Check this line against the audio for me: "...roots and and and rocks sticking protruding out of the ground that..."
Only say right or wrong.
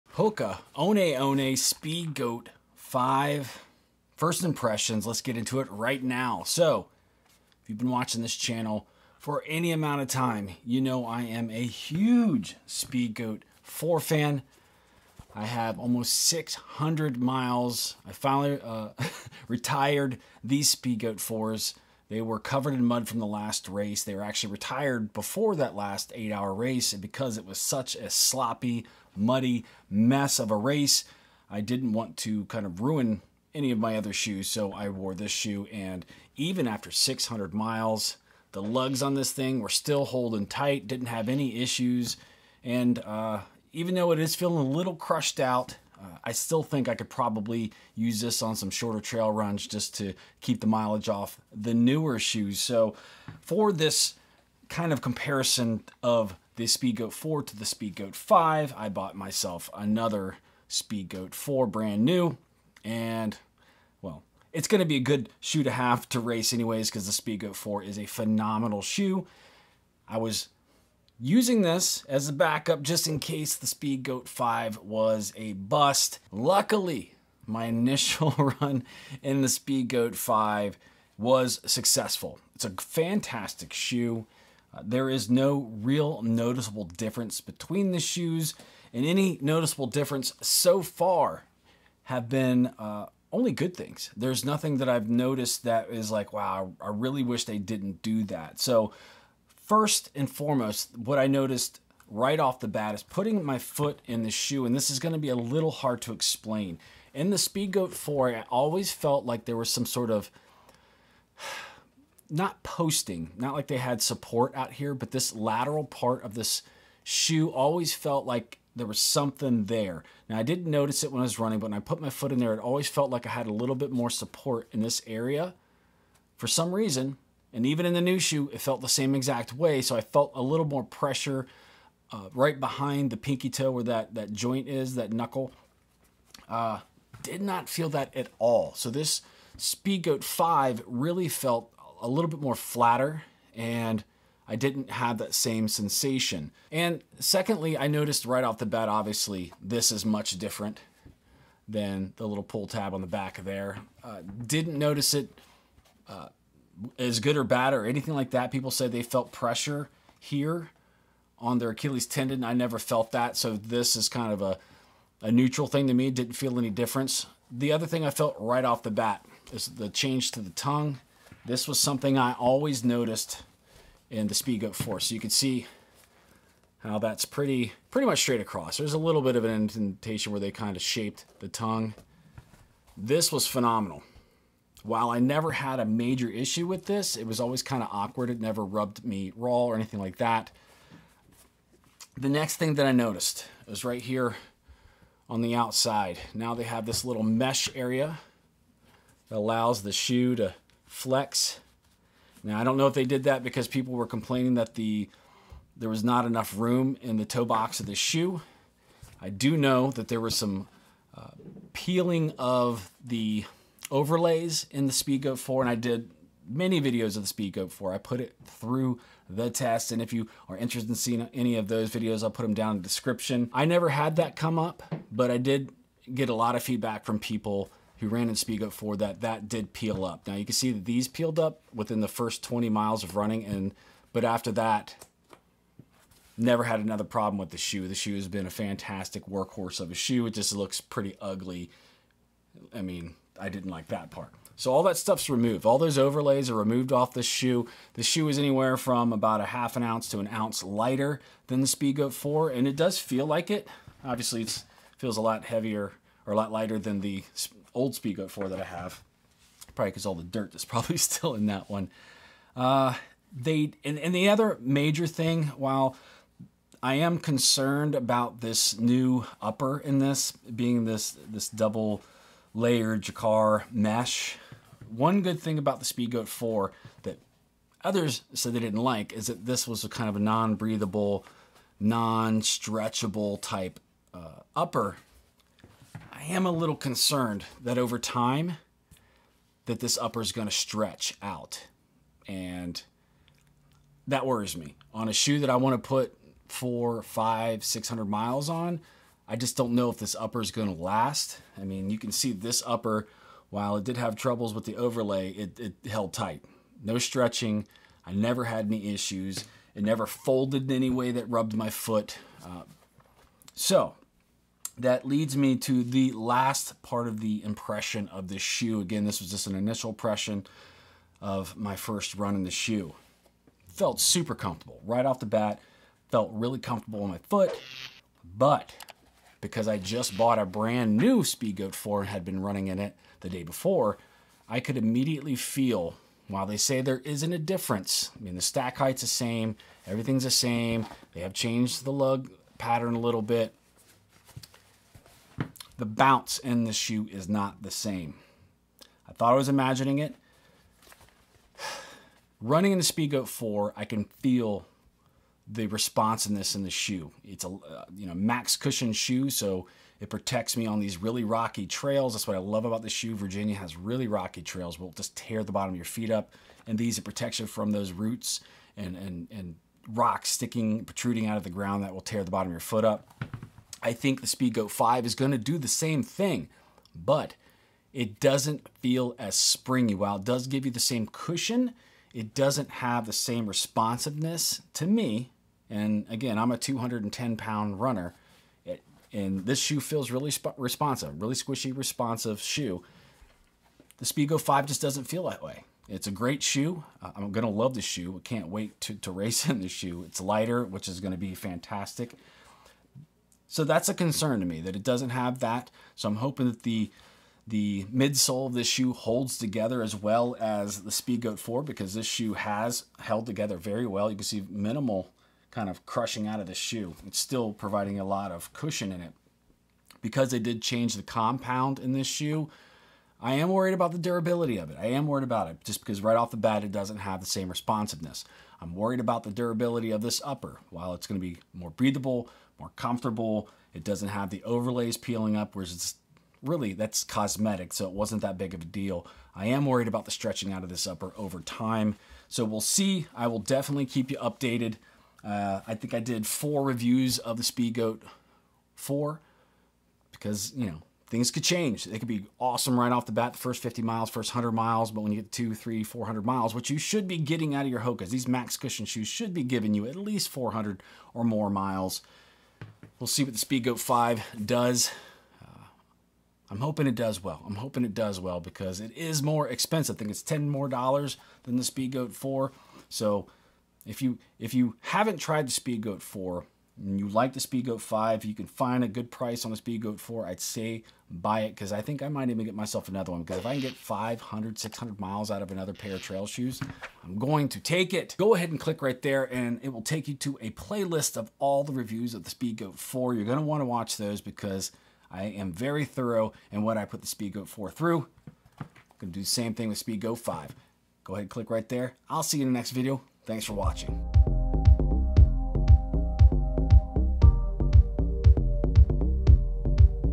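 right.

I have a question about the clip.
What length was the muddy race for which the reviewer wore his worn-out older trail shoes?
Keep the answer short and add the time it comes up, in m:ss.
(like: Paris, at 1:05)
eight hour, at 0:26.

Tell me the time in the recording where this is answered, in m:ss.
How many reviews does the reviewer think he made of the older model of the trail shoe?
7:26.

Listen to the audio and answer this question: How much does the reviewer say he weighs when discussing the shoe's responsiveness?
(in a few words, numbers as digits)
210 pounds.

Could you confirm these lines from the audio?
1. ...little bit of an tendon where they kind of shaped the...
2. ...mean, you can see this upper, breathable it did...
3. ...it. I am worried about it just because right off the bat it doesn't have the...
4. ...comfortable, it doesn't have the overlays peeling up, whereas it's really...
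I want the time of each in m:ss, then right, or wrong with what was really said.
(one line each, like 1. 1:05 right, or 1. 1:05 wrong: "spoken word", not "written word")
1. 2:58 wrong: "indentation", not "tendon"
2. 5:01 wrong: "while", not "breathable"
3. 7:04 right
4. 7:12 right.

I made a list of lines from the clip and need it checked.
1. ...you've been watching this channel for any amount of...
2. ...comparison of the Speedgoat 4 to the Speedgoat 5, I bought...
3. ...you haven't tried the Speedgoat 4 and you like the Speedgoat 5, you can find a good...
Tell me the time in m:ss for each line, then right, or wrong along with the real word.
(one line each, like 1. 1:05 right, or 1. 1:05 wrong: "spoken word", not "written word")
1. 0:07 right
2. 0:55 right
3. 7:54 right.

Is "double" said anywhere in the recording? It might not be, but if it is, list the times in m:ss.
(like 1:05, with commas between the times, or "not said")
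4:31.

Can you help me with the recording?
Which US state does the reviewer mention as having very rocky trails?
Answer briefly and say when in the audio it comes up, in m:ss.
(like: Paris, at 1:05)
Virginia, at 6:03.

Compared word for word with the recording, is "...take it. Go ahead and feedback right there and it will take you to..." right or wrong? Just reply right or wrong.
wrong.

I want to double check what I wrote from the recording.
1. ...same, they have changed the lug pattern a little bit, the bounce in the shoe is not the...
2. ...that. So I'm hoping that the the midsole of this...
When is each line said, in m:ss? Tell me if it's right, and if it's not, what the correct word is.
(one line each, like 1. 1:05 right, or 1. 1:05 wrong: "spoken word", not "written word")
1. 5:40 right
2. 6:45 right.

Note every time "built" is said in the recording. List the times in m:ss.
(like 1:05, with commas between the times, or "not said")
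not said.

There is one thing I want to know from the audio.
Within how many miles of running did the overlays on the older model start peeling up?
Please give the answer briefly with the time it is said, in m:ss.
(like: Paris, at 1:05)
20, at 3:52.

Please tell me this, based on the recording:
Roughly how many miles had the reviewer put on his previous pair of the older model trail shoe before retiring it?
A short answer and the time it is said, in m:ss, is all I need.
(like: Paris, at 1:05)
600, at 0:15.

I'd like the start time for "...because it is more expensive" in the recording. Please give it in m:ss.
7:48.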